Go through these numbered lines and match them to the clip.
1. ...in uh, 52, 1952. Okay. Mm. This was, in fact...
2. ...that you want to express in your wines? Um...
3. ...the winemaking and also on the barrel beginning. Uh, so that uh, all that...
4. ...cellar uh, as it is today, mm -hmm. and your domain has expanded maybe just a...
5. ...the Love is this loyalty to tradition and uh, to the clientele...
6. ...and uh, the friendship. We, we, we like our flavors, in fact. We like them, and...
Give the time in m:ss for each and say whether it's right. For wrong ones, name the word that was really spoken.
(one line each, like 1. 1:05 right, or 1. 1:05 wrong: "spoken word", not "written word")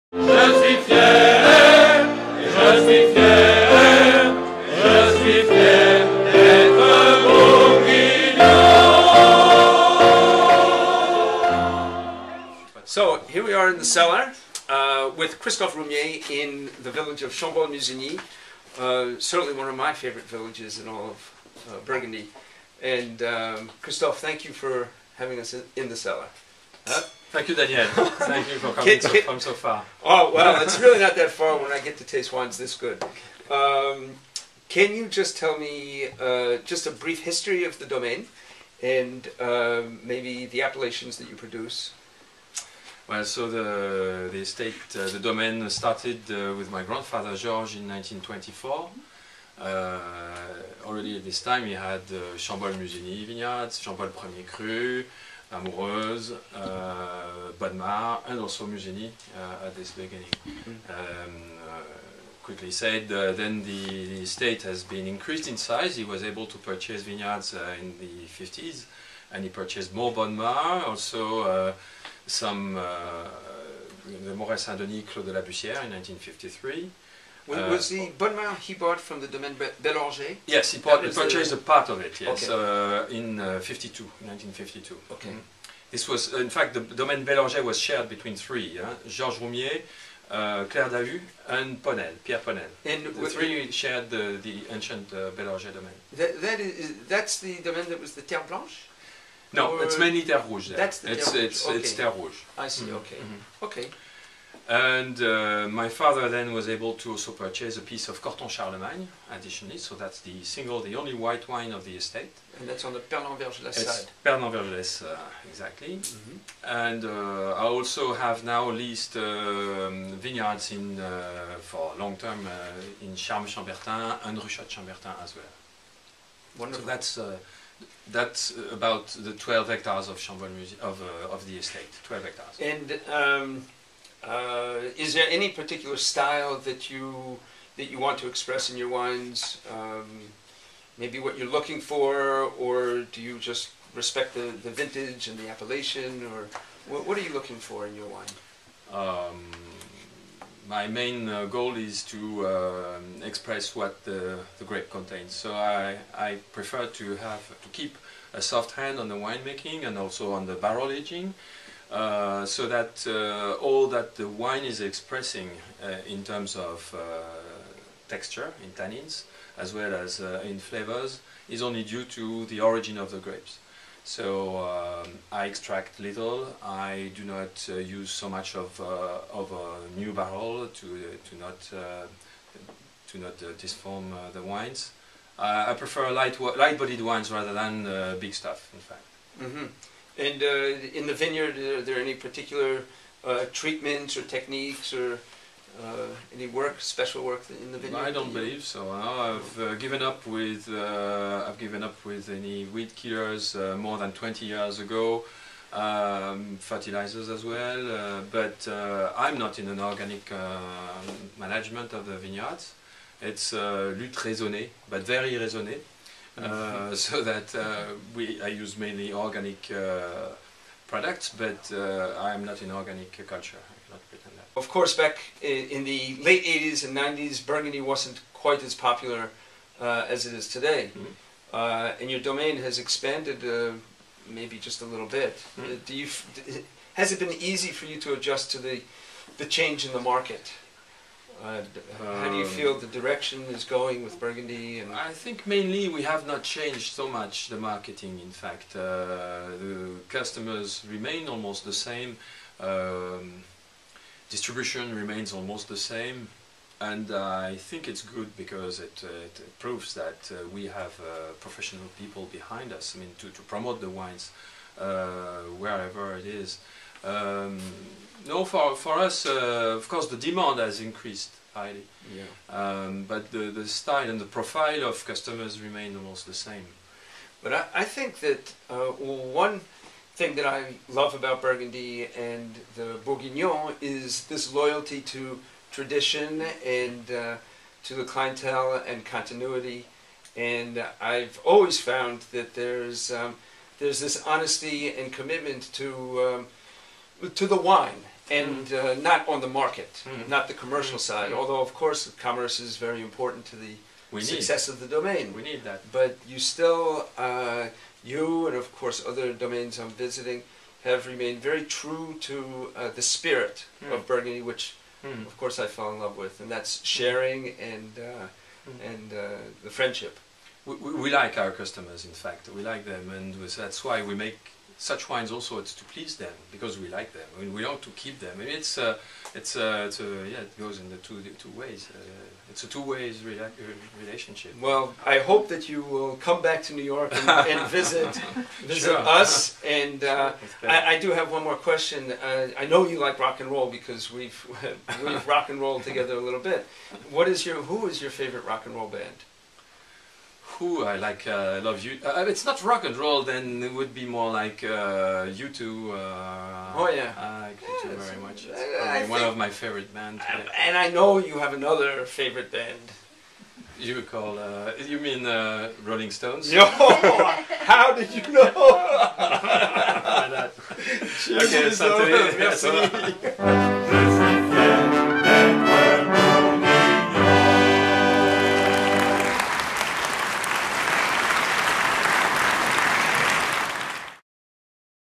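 1. 1:23 right
2. 2:17 right
3. 2:39 wrong: "aging", not "beginning"
4. 3:48 wrong: "popular", not "cellar"
5. 4:42 wrong: "Bourguignon", not "Love"
6. 5:18 wrong: "customers", not "flavors".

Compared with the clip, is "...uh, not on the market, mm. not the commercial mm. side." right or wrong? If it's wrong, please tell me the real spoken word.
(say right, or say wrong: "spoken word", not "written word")
right.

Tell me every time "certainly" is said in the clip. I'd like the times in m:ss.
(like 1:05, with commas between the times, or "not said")
0:19.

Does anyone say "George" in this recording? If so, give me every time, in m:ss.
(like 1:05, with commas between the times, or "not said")
0:47, 1:29.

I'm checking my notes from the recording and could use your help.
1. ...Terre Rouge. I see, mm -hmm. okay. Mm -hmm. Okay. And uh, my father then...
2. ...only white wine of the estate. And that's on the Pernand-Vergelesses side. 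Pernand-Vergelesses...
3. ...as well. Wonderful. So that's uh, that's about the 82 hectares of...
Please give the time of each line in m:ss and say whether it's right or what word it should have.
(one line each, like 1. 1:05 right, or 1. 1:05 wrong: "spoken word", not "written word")
1. 1:41 right
2. 1:50 right
3. 2:05 wrong: "12", not "82".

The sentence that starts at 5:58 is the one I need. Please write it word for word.
Uh, it's one of my favorite bands.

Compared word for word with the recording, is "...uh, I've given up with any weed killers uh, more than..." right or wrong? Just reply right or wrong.
right.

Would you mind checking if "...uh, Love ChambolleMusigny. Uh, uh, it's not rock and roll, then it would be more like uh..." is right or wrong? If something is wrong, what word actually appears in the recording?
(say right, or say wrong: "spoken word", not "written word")
wrong: "You", not "ChambolleMusigny".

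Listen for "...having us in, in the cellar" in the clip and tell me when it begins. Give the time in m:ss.
0:25.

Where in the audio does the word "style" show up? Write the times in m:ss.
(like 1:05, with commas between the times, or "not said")
2:15, 4:33.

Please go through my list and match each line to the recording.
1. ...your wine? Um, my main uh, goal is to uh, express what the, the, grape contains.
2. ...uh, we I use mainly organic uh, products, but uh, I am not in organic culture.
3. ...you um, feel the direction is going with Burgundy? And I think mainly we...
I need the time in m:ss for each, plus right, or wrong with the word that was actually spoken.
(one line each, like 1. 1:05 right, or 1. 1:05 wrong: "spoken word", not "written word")
1. 2:27 right
2. 3:37 right
3. 4:02 right.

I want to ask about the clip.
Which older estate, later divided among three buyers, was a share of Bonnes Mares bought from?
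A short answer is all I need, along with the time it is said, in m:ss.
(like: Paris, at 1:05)
Domaine Bélanger, at 1:19.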